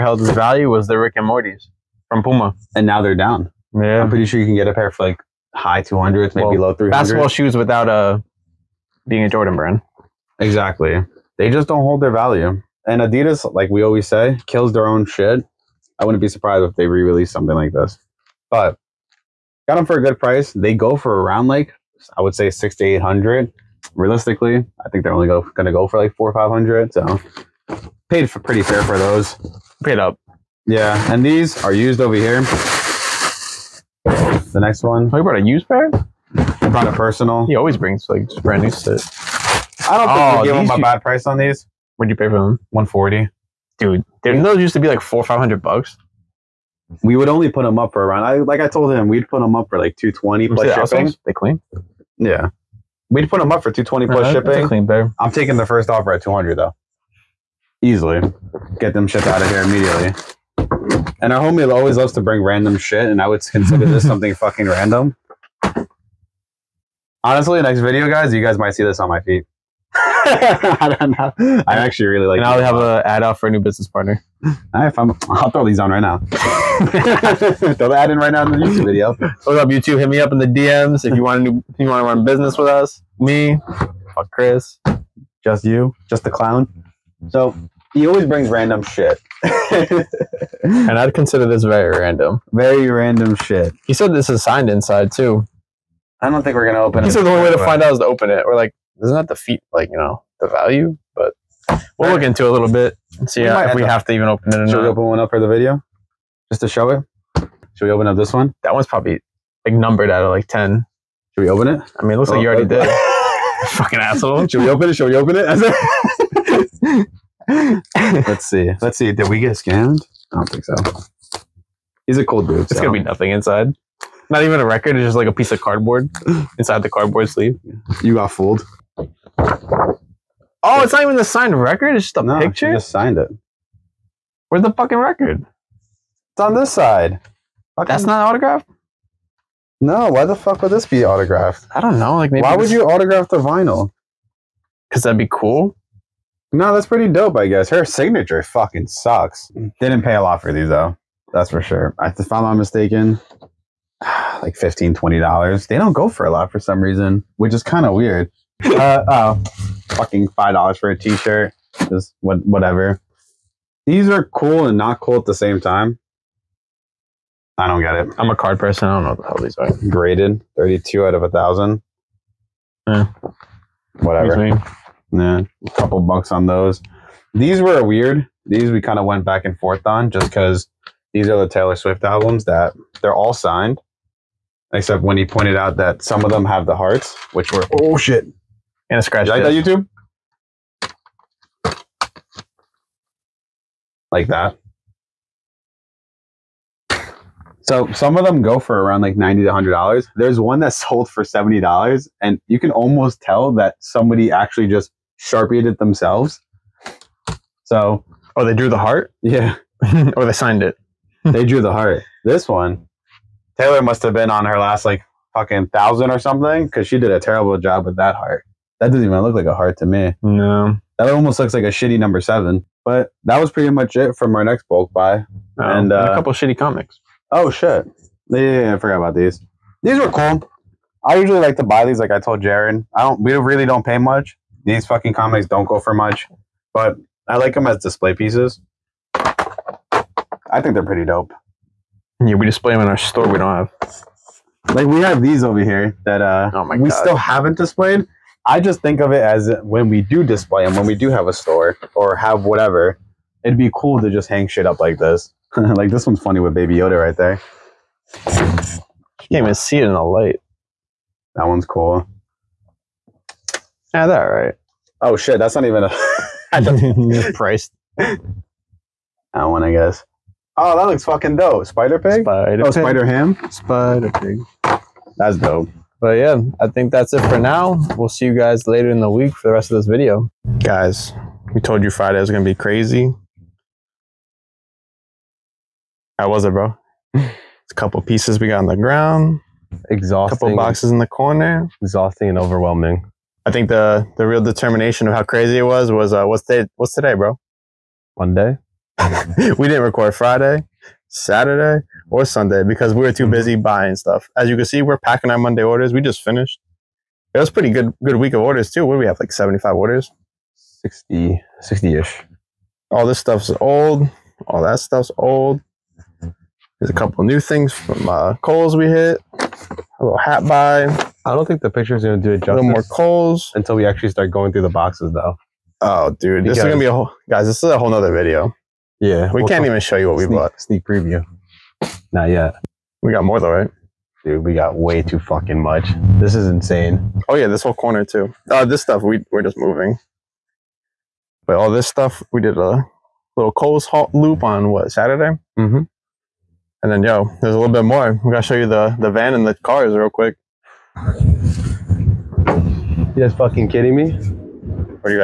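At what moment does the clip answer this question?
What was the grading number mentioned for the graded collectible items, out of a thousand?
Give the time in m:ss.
2:50.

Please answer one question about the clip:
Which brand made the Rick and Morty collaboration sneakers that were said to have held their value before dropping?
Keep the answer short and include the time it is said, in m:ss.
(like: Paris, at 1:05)
Puma, at 0:02.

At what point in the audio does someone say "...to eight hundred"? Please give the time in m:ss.
0:22.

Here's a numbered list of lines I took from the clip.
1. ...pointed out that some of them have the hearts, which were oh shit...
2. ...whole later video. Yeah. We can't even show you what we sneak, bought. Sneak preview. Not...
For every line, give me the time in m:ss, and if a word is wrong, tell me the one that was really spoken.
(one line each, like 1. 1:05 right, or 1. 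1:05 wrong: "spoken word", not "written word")
1. 3:05 right
2. 5:27 wrong: "nother", not "later".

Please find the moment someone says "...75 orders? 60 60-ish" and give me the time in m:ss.
5:09.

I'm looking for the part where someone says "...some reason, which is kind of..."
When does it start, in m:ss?
2:36.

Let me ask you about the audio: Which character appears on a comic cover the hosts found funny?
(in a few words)
Baby Yoda.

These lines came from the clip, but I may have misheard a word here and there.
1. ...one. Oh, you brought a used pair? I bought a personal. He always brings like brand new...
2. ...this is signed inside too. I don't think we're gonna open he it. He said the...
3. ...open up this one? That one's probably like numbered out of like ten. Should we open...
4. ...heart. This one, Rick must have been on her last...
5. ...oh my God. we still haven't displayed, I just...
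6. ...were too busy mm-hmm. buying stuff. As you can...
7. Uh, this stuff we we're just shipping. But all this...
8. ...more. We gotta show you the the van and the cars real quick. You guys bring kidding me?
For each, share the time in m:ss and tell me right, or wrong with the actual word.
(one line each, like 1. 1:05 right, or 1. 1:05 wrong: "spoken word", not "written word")
1. 0:34 wrong: "brought", not "bought"
2. 1:34 right
3. 1:47 right
4. 3:31 wrong: "Taylor", not "Rick"
5. 4:06 right
6. 5:03 right
7. 5:38 wrong: "moving", not "shipping"
8. 5:47 wrong: "fucking", not "bring".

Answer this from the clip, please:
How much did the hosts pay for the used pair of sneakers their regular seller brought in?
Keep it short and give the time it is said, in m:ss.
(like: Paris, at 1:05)
$140, at 0:42.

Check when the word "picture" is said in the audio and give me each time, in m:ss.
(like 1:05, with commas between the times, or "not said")
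2:12, 5:21.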